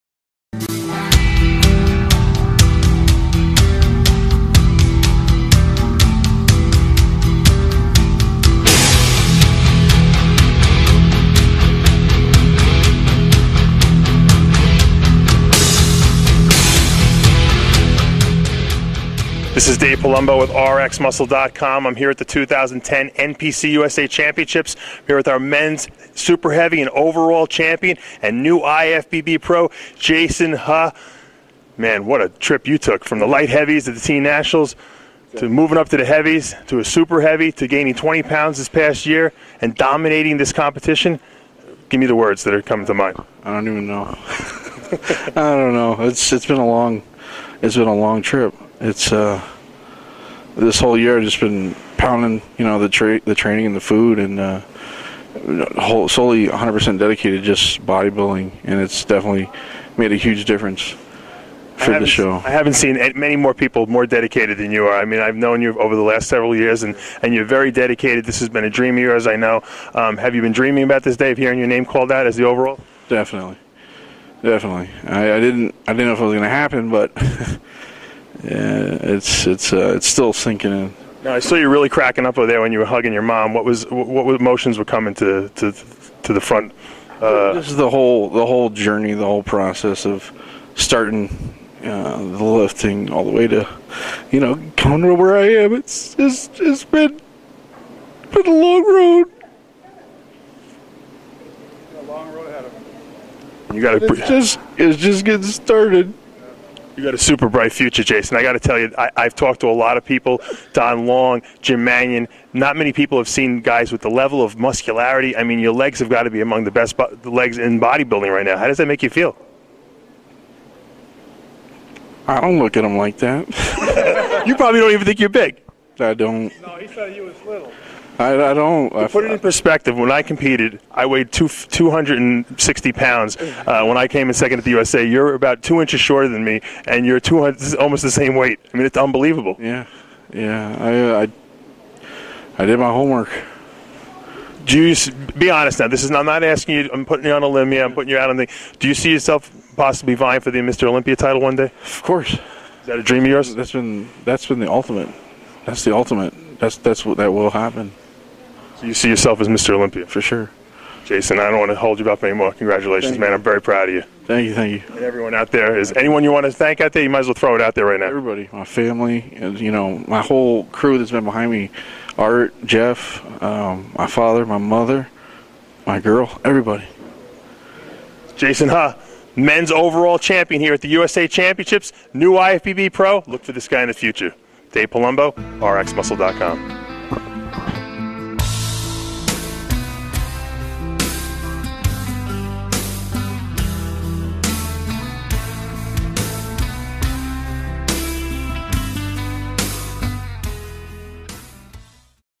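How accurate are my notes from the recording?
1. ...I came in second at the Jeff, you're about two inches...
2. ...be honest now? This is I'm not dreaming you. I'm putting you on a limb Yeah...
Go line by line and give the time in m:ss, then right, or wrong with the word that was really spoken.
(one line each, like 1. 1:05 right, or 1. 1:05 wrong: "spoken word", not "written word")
1. 2:13 wrong: "USA", not "Jeff"
2. 2:25 wrong: "asking", not "dreaming".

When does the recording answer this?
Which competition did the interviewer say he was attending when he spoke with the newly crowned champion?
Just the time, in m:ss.
0:22.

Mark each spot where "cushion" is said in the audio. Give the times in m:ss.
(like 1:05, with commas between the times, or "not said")
not said.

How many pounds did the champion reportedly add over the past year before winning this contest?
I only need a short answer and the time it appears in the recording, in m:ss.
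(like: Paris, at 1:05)
20, at 0:37.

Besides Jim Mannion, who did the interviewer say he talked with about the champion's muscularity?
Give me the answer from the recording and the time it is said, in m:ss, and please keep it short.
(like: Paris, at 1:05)
Don Long, at 1:50.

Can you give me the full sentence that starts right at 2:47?
You might as well throw it out there right now.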